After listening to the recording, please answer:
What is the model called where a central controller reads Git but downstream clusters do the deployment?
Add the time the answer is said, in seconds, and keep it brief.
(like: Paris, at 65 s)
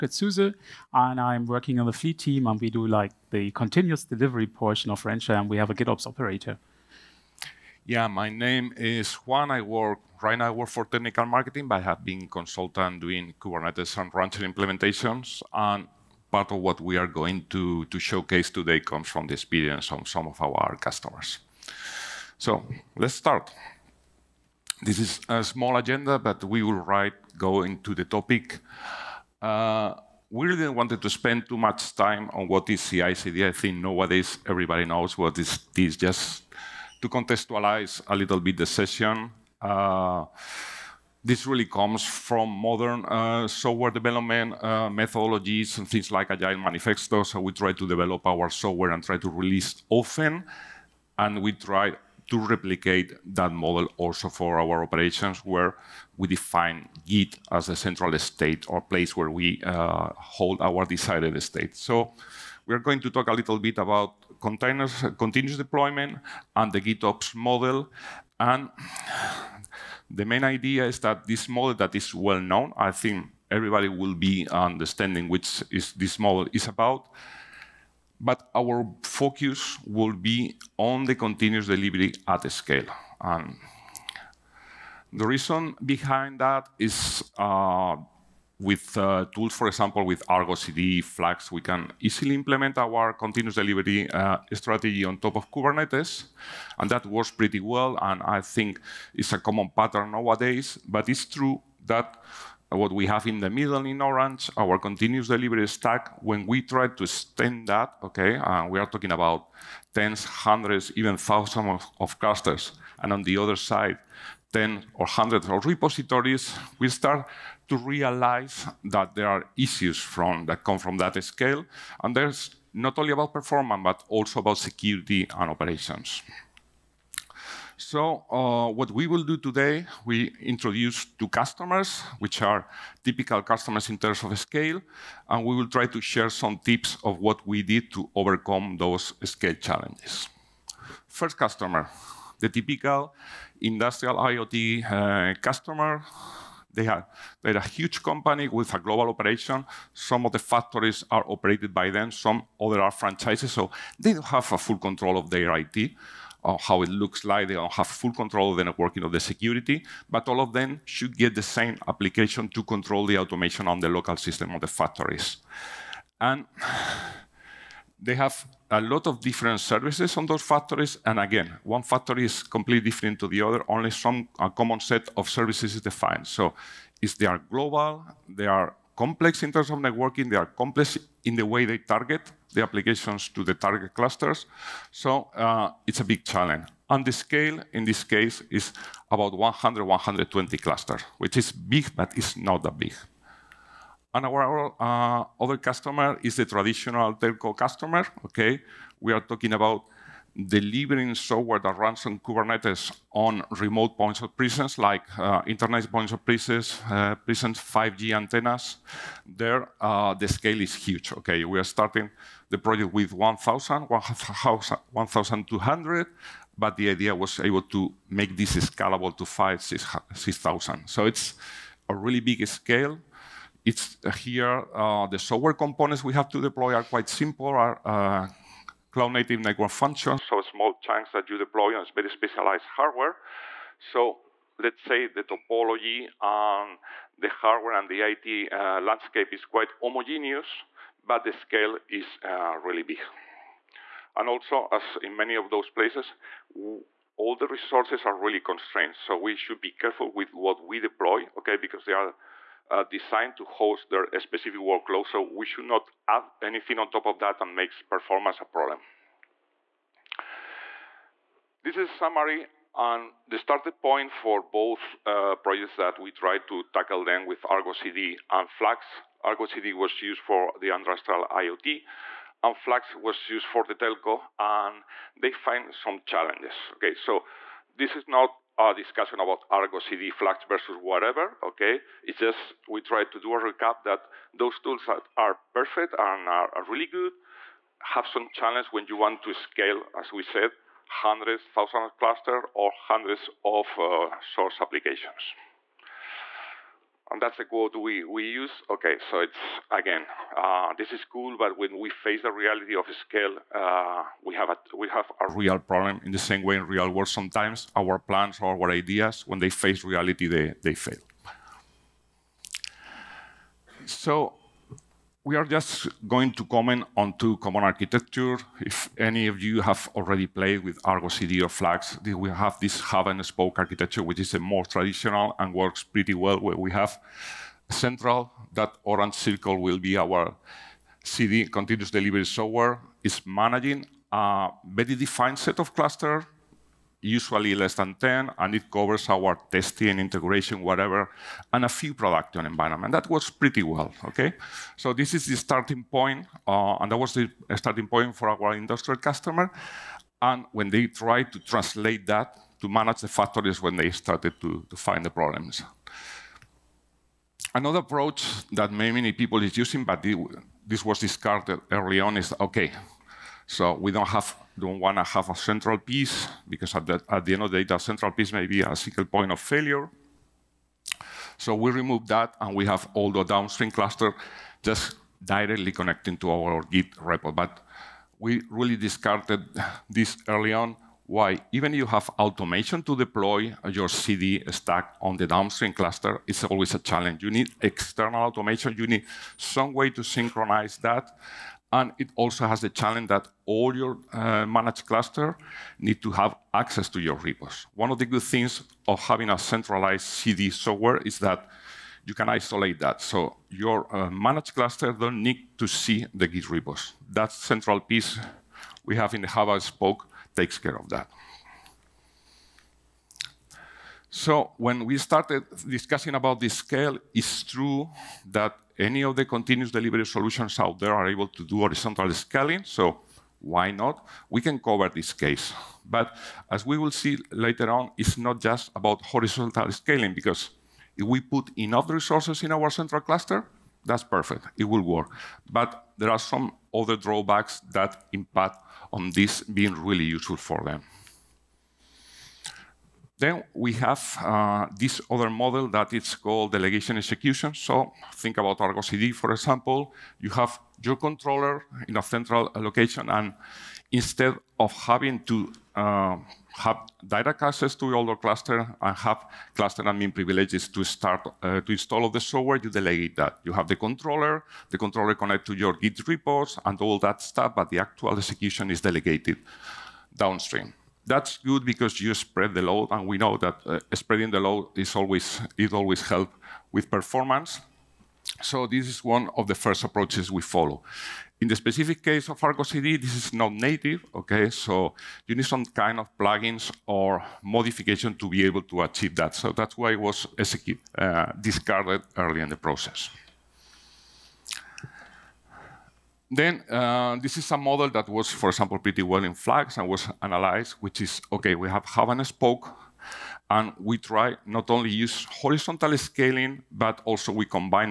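delegation execution, at 446 s.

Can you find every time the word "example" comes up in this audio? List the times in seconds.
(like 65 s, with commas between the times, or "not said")
89 s, 449 s, 498 s.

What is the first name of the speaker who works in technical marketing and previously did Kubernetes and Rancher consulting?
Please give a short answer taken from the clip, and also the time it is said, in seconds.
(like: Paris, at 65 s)
Juan, at 9 s.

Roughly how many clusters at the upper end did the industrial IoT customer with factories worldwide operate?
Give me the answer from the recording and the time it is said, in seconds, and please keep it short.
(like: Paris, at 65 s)
120, at 189 s.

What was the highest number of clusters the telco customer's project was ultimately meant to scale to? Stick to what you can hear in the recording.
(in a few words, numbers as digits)
6,000.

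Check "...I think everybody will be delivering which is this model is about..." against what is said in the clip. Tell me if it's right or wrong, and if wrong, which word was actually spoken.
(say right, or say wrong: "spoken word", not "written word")
wrong: "understanding", not "delivering".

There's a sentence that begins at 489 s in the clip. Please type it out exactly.
So that's why it was uh, discarded early in the process.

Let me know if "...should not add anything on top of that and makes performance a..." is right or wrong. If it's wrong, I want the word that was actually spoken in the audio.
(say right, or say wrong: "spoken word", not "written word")
right.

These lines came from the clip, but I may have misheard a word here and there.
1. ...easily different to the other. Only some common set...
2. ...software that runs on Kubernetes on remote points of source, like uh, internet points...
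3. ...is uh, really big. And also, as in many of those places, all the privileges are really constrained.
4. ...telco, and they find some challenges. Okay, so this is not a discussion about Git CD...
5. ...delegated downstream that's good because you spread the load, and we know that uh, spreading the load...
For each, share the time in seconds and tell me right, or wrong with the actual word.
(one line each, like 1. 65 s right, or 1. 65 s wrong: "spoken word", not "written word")
1. 172 s wrong: "completely", not "easily"
2. 201 s wrong: "presence", not "source"
3. 241 s wrong: "resources", not "privileges"
4. 273 s wrong: "Argo", not "Git"
5. 468 s right.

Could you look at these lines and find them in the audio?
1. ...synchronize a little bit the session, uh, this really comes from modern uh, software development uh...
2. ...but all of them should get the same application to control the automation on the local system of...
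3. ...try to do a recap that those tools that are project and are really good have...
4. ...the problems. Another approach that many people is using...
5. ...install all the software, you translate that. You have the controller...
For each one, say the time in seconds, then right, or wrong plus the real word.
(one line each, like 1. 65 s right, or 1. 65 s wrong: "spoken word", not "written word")
1. 37 s wrong: "contextualize", not "synchronize"
2. 160 s right
3. 282 s wrong: "perfect", not "project"
4. 355 s right
5. 461 s wrong: "delegate", not "translate".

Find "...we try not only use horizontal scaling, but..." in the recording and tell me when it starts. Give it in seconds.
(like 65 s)
503 s.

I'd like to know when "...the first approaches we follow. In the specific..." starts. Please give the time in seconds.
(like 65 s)
479 s.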